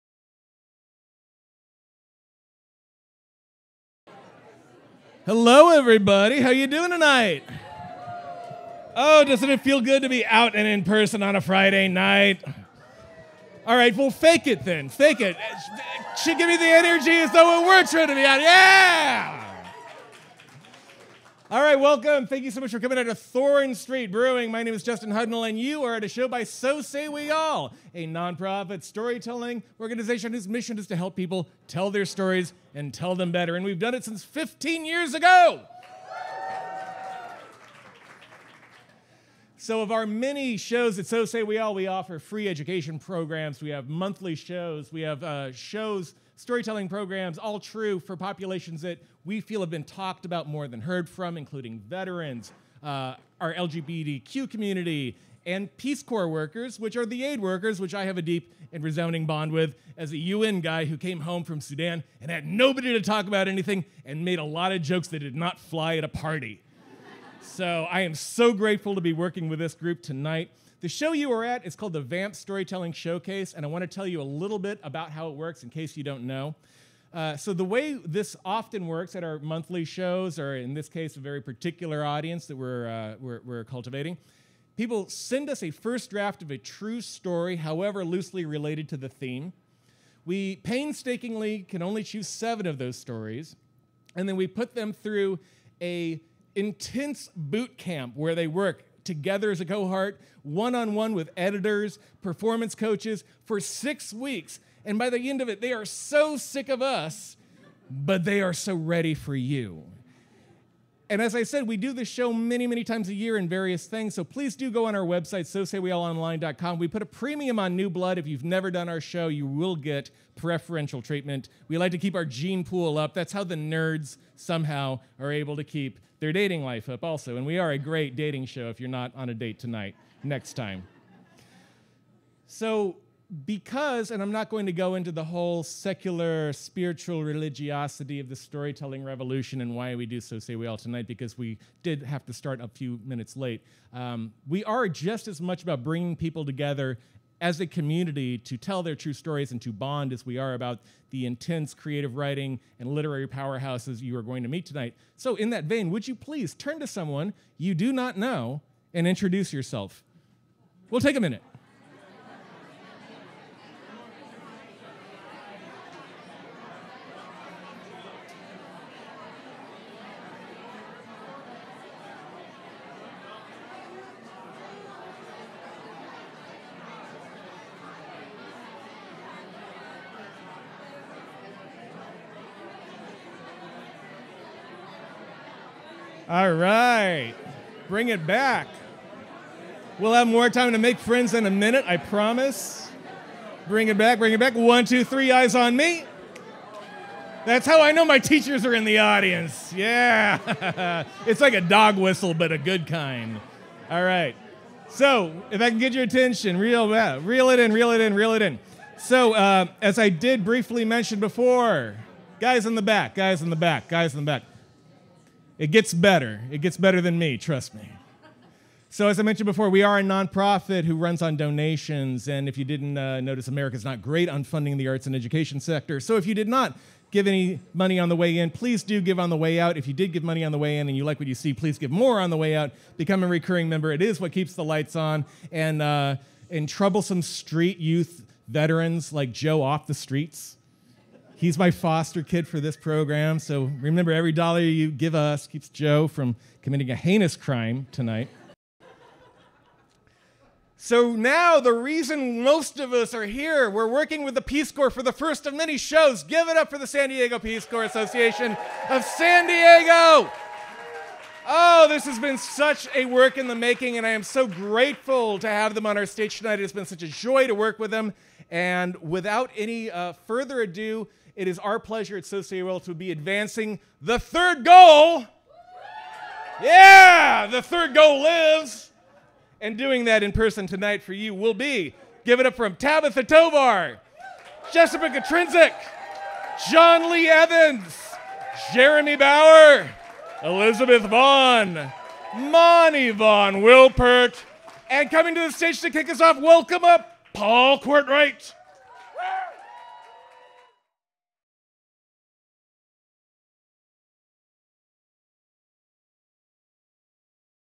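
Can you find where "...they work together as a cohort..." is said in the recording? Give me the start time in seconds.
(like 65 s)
98 s.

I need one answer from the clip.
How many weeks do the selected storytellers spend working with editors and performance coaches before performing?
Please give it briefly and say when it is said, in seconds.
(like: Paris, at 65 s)
6, at 103 s.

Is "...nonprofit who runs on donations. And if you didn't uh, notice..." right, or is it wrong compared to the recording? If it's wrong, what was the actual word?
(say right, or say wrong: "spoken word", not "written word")
right.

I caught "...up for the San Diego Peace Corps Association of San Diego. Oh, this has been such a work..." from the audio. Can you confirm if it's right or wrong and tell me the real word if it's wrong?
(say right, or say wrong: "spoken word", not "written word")
right.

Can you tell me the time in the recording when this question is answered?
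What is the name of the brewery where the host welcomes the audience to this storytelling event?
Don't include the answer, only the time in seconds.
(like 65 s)
23 s.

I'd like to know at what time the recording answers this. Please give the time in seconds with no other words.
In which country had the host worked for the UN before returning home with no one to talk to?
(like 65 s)
61 s.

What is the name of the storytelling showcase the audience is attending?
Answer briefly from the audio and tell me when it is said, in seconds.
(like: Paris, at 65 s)
VAMP Storytelling Showcase, at 72 s.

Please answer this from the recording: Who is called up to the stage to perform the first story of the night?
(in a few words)
Paul Courtright.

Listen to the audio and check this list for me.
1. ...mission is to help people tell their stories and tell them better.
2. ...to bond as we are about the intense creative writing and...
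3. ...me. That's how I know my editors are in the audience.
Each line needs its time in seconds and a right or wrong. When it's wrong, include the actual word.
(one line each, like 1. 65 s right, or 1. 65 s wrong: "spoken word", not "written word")
1. 30 s right
2. 149 s right
3. 195 s wrong: "teachers", not "editors".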